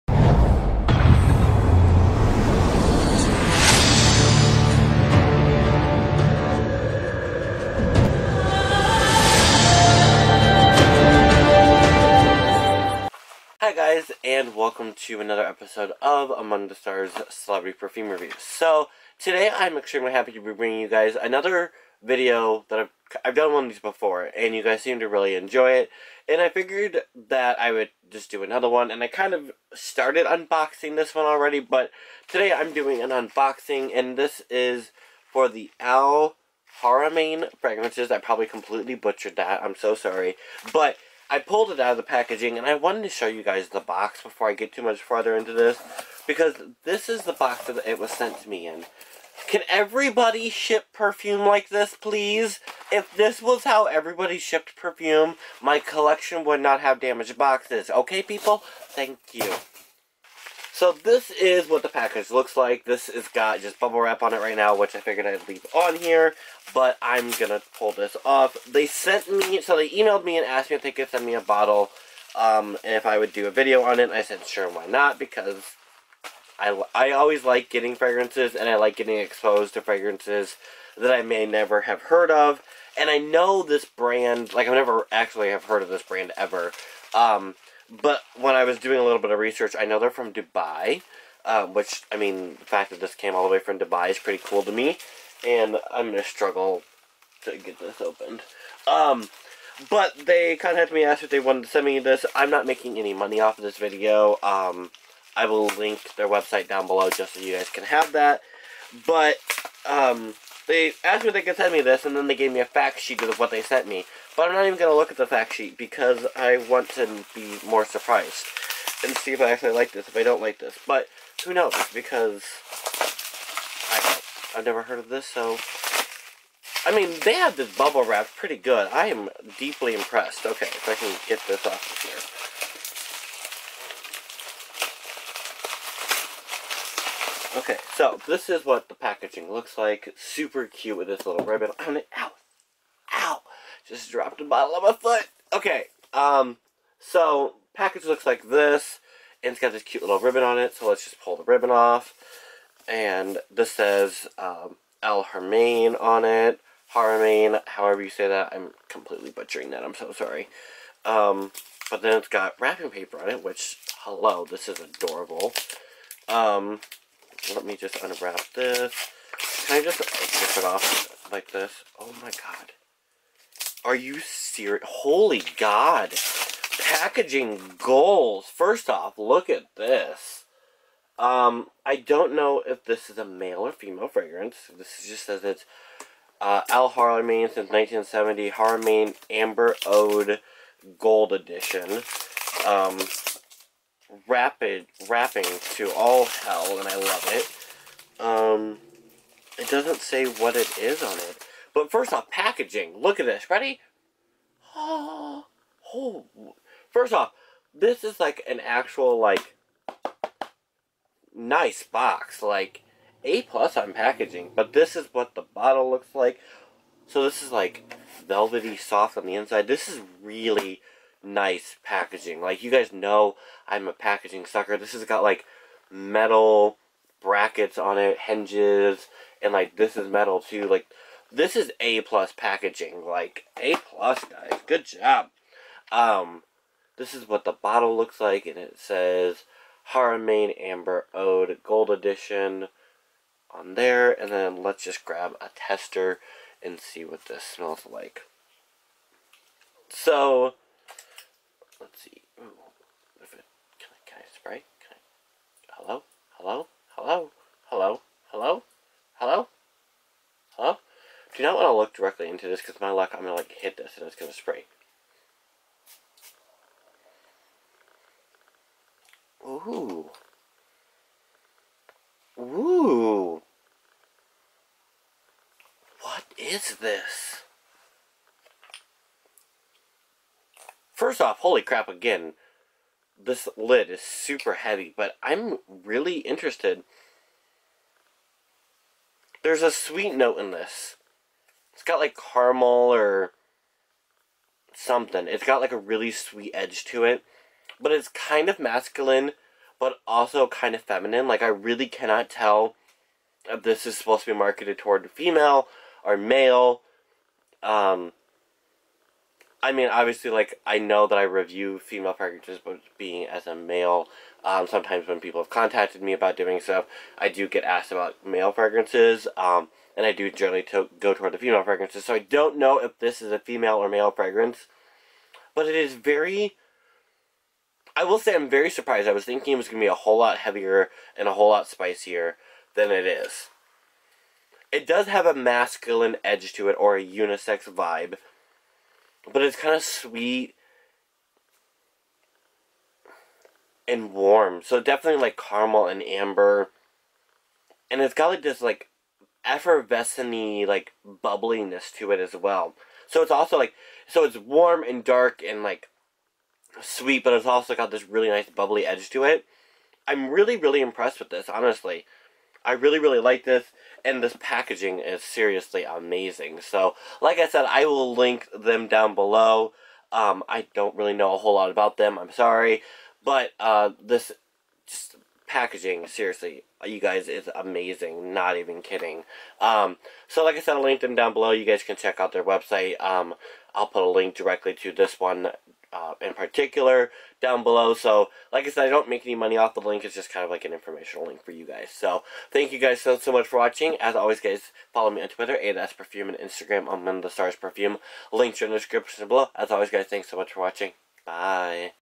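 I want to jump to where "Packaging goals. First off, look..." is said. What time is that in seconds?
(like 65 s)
176 s.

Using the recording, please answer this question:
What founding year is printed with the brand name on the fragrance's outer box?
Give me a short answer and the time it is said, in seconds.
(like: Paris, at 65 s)
1970, at 187 s.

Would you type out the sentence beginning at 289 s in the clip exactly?
There's a sweet note in this.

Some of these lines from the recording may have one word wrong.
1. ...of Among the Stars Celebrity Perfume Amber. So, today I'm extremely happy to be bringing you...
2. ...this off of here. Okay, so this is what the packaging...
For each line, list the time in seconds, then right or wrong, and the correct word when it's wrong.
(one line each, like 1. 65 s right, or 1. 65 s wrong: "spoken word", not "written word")
1. 16 s wrong: "Review", not "Amber"
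2. 131 s right.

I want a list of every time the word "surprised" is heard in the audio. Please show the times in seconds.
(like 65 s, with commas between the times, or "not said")
117 s, 328 s.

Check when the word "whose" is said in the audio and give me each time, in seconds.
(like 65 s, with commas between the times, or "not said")
not said.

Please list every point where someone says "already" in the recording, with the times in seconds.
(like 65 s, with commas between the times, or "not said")
31 s.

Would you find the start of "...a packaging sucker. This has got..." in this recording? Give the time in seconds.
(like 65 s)
223 s.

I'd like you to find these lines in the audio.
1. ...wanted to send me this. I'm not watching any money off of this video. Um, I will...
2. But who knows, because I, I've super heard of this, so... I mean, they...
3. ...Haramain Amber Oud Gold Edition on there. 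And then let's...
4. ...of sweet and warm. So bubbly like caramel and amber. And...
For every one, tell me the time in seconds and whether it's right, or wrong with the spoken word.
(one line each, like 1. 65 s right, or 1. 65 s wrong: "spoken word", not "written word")
1. 101 s wrong: "making", not "watching"
2. 120 s wrong: "never", not "super"
3. 239 s right
4. 339 s wrong: "definitely", not "bubbly".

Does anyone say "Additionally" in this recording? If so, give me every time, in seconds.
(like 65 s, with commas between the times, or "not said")
not said.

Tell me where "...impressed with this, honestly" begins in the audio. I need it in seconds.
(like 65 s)
360 s.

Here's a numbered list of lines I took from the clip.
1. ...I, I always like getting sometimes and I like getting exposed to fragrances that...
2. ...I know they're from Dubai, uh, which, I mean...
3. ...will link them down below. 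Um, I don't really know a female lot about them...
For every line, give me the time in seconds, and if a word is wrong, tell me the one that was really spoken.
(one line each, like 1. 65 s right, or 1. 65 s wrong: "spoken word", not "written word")
1. 76 s wrong: "fragrances", not "sometimes"
2. 89 s right
3. 367 s wrong: "whole", not "female".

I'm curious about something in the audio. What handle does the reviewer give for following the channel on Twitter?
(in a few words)
ADS Perfume.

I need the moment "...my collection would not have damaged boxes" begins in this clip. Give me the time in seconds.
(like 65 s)
55 s.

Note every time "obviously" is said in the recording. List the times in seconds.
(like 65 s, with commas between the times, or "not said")
309 s.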